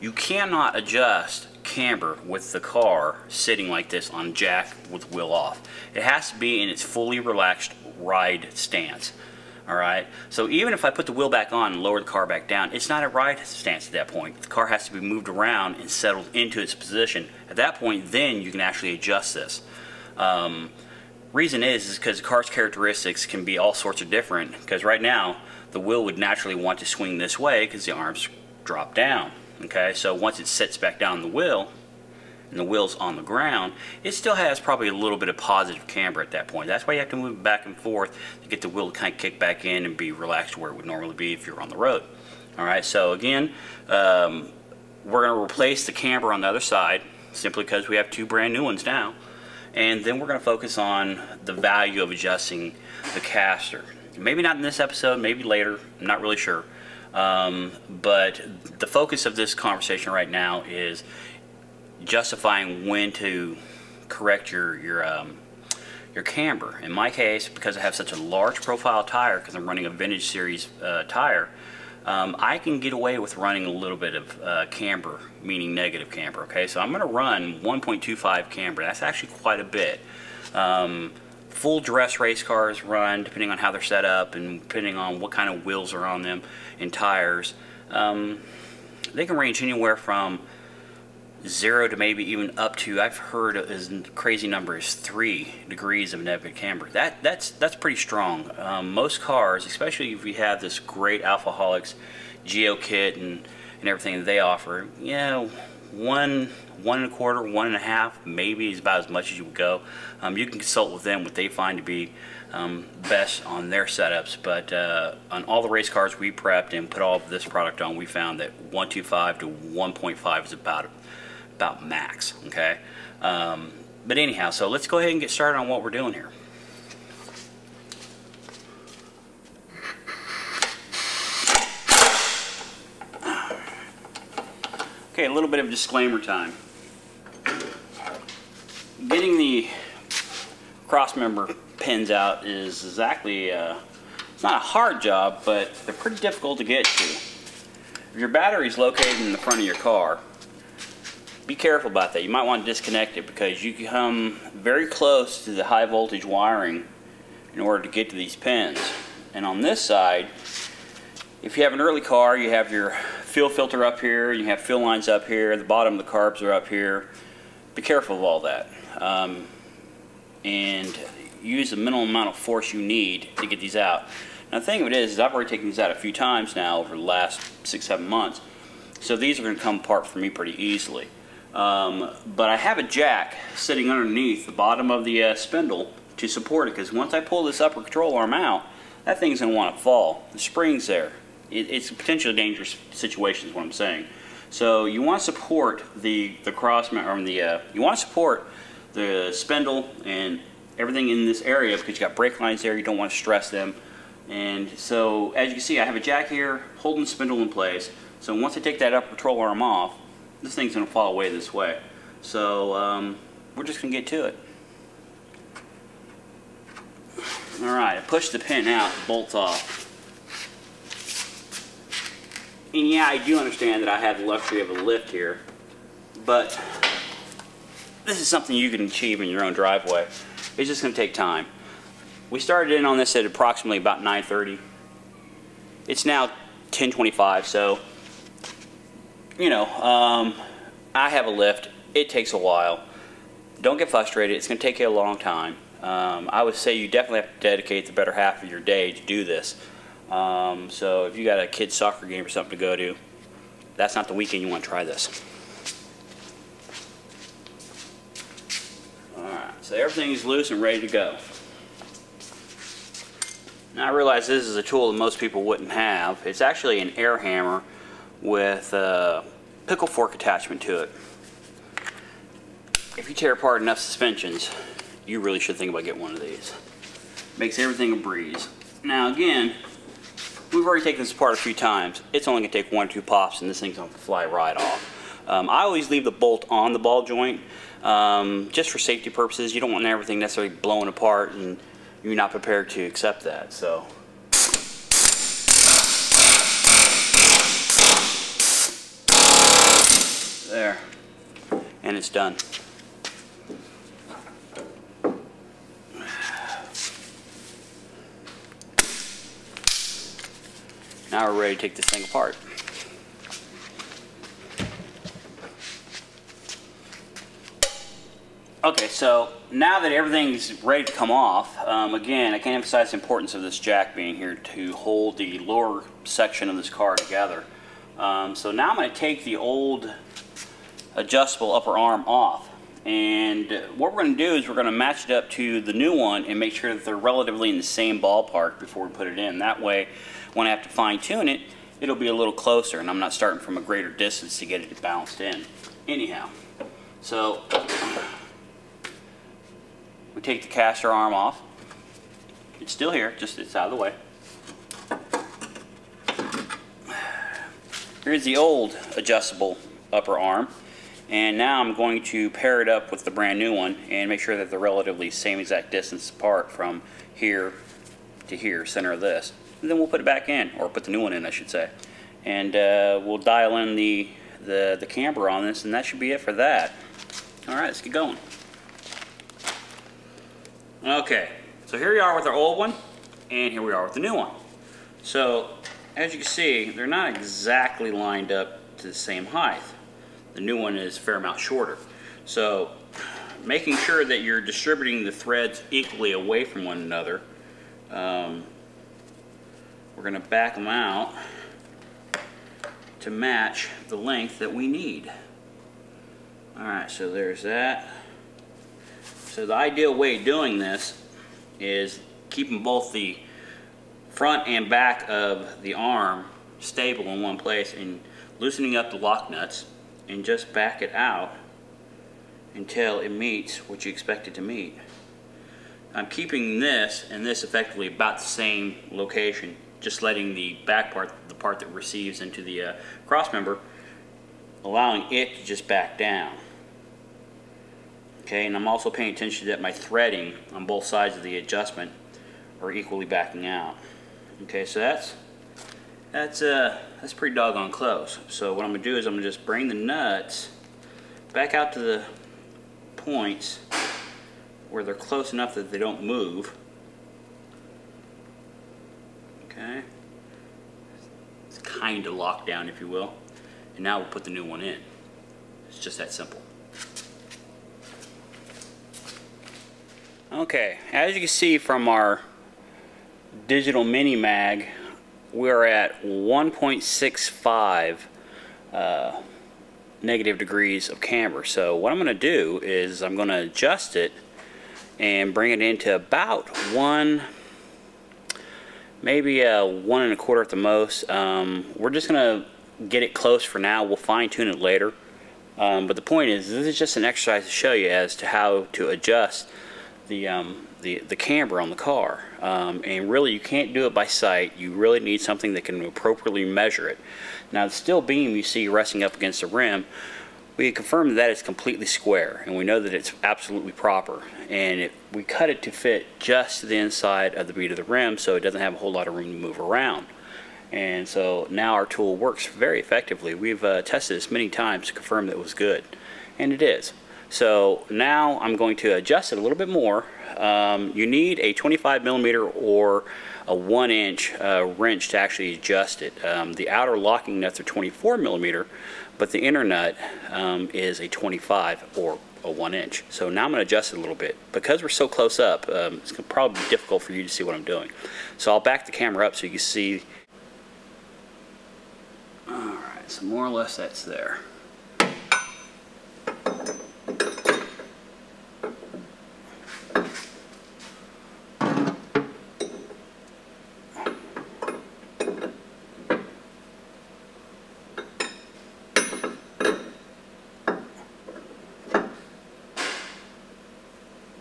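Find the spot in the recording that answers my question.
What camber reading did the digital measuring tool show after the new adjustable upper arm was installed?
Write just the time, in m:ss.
7:56.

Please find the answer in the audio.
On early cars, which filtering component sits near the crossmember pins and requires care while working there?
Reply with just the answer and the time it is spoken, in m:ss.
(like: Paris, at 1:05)
Fuel filter, at 2:43.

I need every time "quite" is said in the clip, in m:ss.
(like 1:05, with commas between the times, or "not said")
1:19.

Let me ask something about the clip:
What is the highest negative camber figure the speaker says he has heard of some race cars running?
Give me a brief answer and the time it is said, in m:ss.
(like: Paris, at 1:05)
3 degrees, at 1:34.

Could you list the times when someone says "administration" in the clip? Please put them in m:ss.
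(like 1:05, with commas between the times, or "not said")
not said.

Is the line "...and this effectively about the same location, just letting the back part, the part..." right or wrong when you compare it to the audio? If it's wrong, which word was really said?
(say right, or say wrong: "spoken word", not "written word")
right.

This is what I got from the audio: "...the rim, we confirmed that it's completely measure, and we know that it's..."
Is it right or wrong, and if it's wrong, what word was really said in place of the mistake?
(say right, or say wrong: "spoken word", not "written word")
wrong: "square", not "measure".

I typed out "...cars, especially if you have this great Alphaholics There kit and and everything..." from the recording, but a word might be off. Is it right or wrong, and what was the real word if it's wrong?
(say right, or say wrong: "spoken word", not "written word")
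wrong: "Geo", not "There".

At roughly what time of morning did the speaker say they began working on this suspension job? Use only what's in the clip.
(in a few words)
9:30.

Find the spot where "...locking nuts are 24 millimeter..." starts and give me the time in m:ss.
8:56.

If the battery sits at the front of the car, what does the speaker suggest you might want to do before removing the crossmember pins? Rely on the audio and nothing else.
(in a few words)
Disconnect it.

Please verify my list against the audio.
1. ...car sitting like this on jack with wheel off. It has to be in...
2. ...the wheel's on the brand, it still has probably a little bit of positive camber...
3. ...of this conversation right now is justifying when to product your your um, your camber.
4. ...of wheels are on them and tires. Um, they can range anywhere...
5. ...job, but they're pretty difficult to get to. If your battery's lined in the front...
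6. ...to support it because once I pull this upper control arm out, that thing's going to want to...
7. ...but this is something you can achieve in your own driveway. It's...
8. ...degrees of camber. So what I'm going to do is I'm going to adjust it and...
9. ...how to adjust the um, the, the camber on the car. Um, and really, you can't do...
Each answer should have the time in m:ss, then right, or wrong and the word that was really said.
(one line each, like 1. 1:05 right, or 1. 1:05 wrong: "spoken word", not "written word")
1. 0:02 right
2. 0:32 wrong: "ground", not "brand"
3. 0:59 wrong: "correct", not "product"
4. 1:25 right
5. 2:24 wrong: "located", not "lined"
6. 3:06 right
7. 3:46 right
8. 8:00 right
9. 8:18 right.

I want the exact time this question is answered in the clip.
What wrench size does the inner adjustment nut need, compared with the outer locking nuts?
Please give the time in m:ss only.
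8:51.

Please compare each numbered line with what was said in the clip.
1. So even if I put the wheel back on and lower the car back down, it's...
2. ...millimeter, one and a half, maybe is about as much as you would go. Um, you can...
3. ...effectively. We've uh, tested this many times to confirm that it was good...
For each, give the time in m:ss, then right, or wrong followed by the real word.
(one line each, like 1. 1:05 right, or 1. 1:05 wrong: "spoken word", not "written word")
1. 0:10 right
2. 1:47 wrong: "quarter", not "millimeter"
3. 8:42 right.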